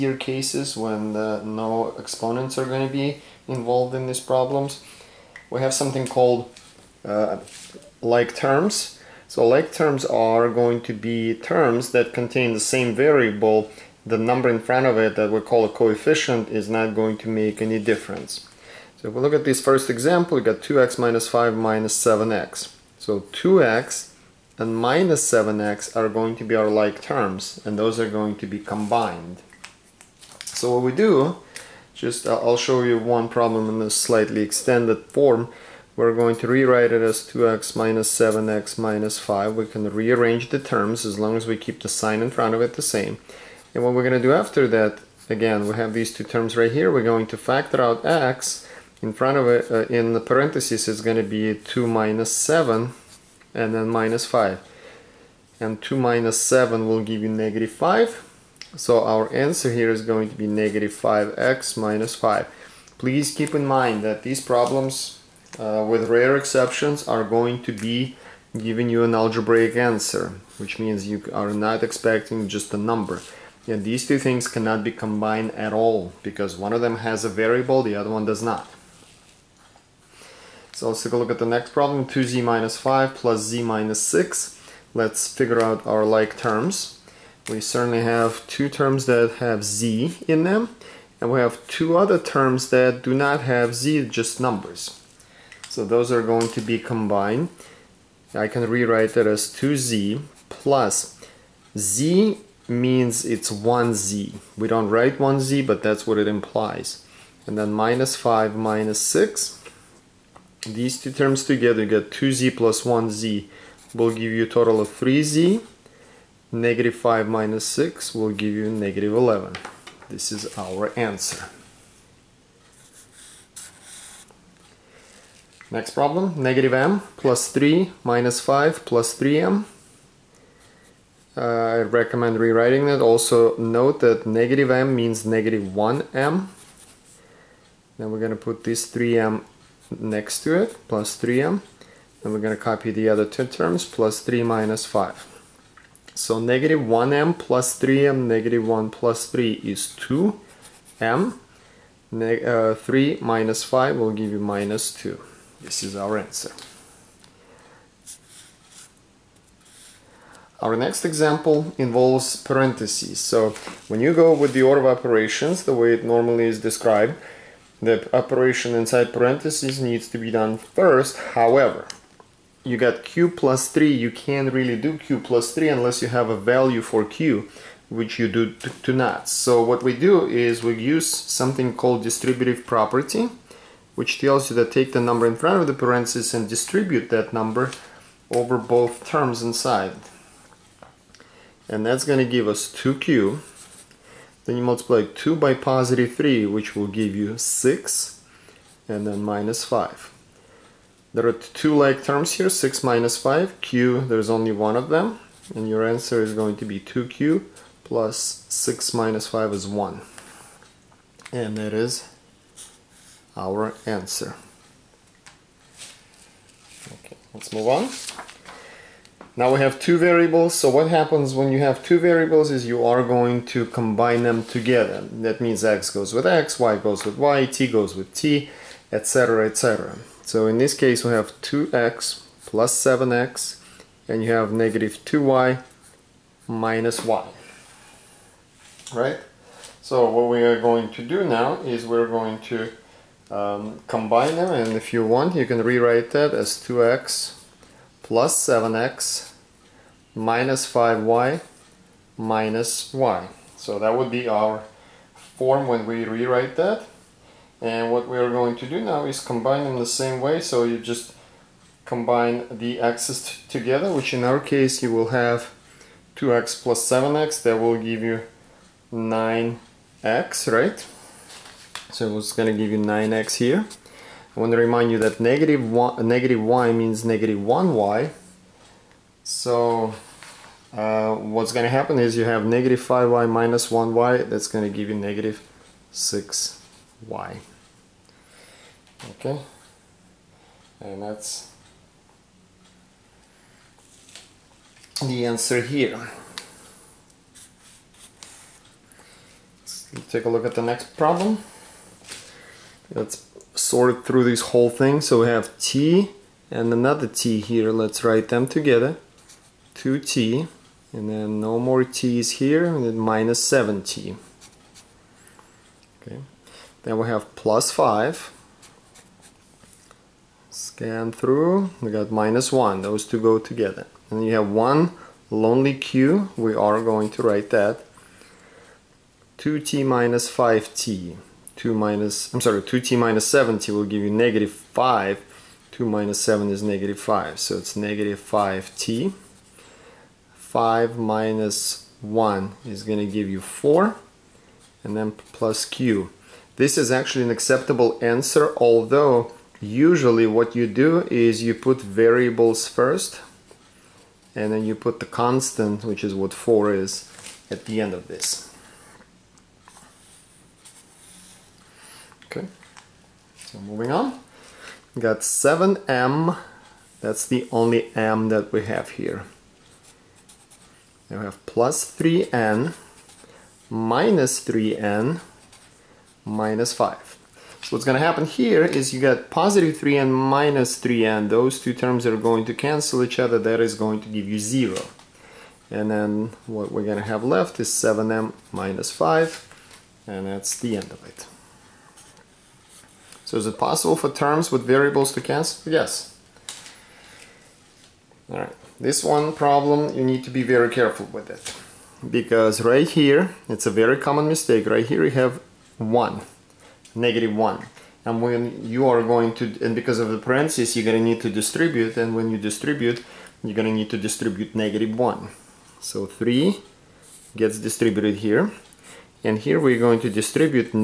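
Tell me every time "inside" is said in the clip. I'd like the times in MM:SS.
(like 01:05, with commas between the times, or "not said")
02:48, 03:09.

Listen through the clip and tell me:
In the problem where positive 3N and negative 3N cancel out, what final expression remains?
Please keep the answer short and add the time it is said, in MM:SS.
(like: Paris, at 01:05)
7M - 5, at 06:27.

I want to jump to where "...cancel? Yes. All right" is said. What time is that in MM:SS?
06:35.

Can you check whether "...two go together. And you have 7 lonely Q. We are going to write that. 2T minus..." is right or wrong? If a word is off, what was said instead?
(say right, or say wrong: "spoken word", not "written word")
wrong: "1", not "7".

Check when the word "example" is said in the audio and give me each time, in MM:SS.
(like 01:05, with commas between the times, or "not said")
00:19, 02:41.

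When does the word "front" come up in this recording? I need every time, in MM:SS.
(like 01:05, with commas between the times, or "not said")
00:14, 00:42, 00:49, 03:05.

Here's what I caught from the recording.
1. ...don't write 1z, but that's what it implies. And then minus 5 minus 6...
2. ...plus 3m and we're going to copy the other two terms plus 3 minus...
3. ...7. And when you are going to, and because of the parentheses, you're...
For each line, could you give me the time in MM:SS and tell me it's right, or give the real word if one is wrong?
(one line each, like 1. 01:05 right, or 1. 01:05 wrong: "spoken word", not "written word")
1. 01:44 right
2. 02:20 right
3. 06:47 wrong: "1", not "7".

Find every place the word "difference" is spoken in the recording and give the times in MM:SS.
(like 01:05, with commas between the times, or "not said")
00:17.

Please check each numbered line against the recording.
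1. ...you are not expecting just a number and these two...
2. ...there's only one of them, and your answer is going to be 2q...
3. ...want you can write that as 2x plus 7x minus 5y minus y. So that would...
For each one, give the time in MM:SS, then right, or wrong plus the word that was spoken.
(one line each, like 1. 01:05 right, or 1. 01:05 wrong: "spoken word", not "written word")
1. 01:11 right
2. 03:24 right
3. 04:05 wrong: "rewrite", not "write".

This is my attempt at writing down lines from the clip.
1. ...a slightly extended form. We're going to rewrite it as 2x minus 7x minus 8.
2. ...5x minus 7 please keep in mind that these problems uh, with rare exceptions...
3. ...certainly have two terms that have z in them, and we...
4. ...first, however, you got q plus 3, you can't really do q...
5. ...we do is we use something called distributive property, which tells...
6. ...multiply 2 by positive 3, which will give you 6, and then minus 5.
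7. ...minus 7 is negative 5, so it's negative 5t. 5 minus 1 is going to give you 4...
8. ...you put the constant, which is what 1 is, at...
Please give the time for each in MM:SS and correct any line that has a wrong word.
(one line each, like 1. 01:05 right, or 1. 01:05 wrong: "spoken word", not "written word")
1. 00:33 wrong: "5", not "8"
2. 01:00 wrong: "5", not "7"
3. 01:27 right
4. 02:50 right
5. 02:59 right
6. 03:14 right
7. 05:35 right
8. 05:54 wrong: "4", not "1".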